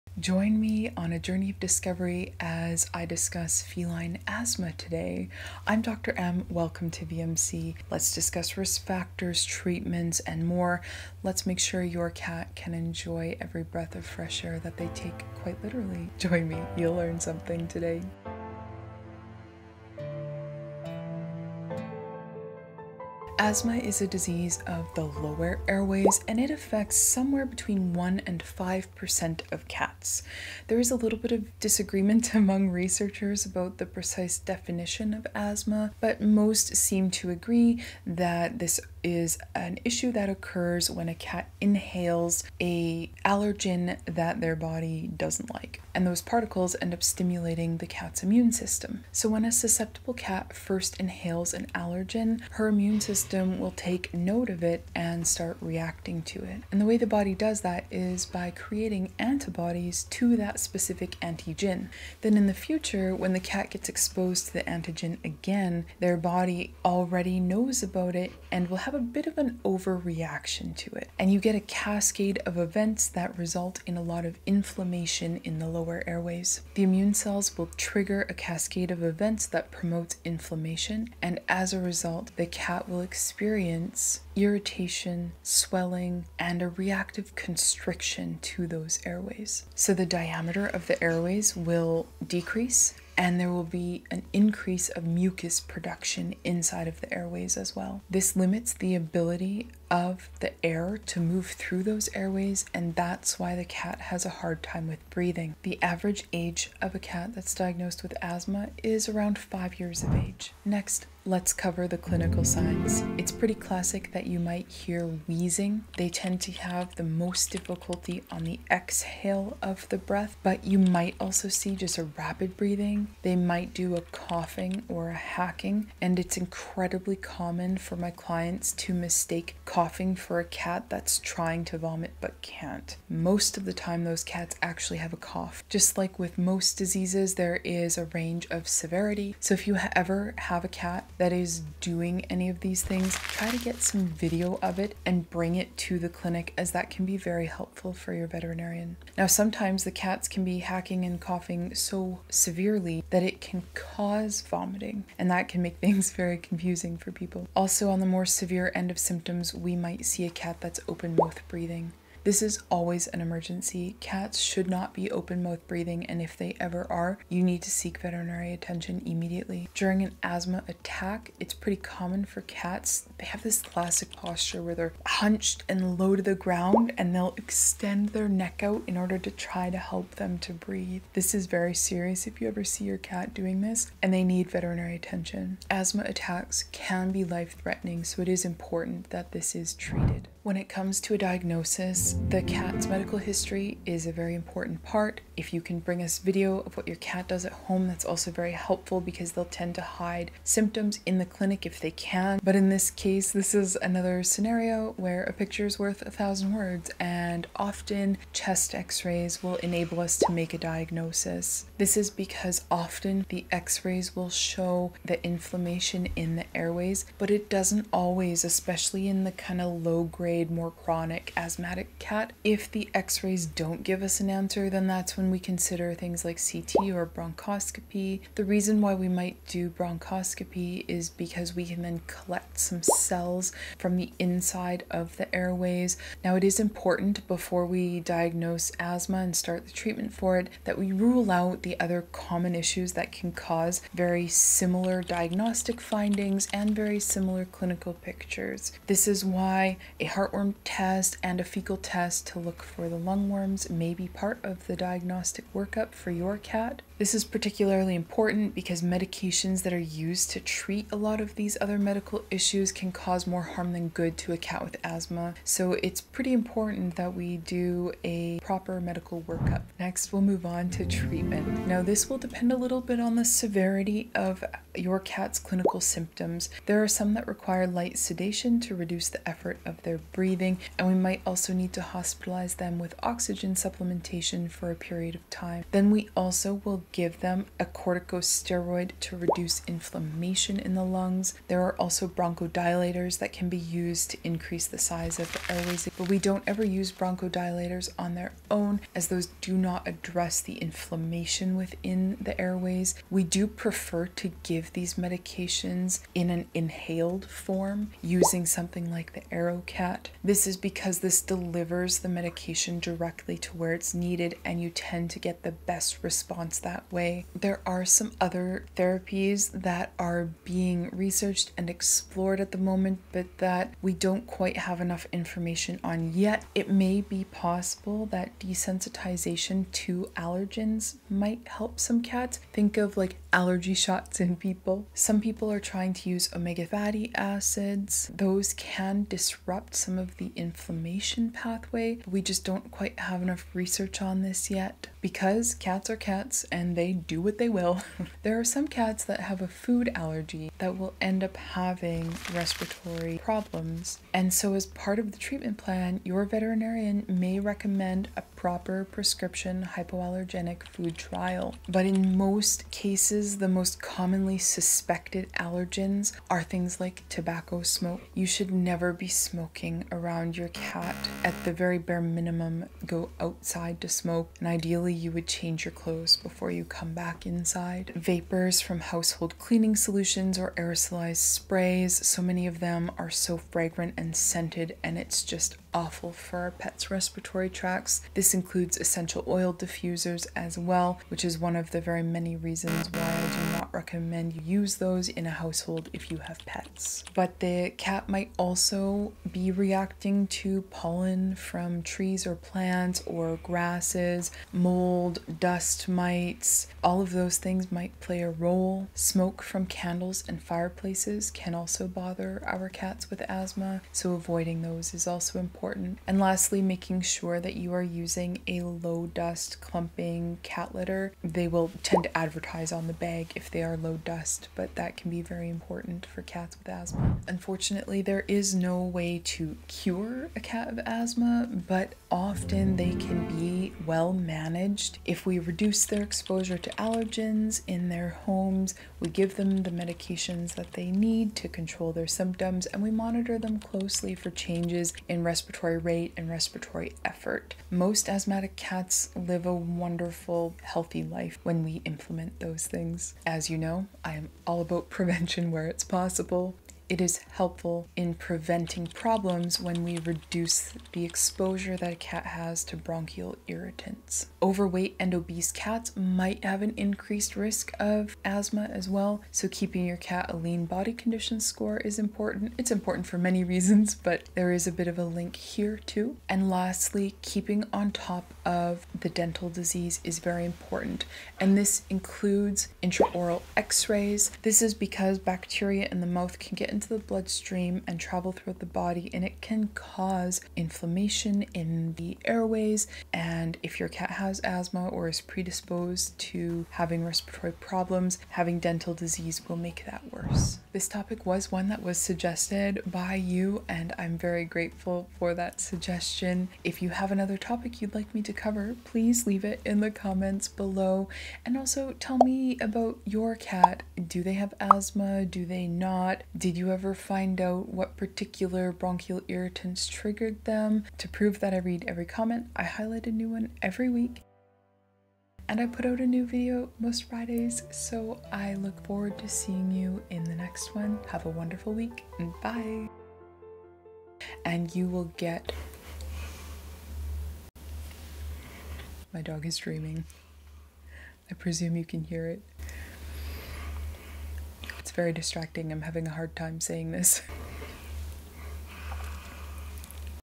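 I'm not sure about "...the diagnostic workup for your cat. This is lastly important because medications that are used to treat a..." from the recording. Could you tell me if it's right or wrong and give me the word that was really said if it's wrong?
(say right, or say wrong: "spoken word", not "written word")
wrong: "particularly", not "lastly".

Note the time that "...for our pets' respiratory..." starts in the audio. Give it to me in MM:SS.
06:26.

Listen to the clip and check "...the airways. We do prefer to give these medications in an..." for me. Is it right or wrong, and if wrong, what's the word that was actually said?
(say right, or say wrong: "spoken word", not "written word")
right.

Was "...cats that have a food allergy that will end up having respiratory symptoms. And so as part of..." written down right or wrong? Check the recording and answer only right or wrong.
wrong.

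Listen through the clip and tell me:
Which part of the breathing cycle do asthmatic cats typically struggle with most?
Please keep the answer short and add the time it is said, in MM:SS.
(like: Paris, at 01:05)
The exhale, at 01:58.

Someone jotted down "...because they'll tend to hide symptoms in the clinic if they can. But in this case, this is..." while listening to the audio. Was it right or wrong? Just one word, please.
right.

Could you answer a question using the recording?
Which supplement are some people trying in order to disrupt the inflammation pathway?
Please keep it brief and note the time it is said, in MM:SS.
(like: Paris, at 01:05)
Omega fatty acids, at 05:36.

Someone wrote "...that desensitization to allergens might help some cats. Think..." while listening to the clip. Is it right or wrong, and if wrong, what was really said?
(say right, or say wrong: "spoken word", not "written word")
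right.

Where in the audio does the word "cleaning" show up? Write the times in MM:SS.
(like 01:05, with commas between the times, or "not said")
06:19.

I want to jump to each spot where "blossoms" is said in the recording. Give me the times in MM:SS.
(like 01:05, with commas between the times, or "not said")
not said.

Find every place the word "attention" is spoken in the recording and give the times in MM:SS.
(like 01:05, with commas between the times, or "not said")
02:48, 03:04.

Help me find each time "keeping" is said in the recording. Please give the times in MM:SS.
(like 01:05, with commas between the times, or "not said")
07:49, 07:57.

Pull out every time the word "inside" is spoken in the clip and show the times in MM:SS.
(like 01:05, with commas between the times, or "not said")
01:36, 03:54, 06:17.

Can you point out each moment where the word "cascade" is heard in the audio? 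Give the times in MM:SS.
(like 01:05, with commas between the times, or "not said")
01:11, 01:18.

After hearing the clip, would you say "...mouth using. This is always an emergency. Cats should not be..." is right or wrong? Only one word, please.
wrong.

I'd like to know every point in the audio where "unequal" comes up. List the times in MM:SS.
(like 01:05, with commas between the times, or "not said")
not said.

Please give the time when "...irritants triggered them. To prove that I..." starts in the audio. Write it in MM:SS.
08:39.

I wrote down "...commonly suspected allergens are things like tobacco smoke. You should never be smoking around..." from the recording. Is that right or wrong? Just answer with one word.
right.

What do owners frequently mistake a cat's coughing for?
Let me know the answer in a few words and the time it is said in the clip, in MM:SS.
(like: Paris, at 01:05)
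Trying to vomit, at 02:11.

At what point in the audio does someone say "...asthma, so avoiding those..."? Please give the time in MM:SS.
06:53.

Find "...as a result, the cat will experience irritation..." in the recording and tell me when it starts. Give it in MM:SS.
01:21.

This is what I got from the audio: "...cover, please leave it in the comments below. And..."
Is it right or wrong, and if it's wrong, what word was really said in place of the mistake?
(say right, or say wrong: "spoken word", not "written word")
right.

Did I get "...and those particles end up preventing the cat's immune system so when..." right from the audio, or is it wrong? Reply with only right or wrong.
wrong.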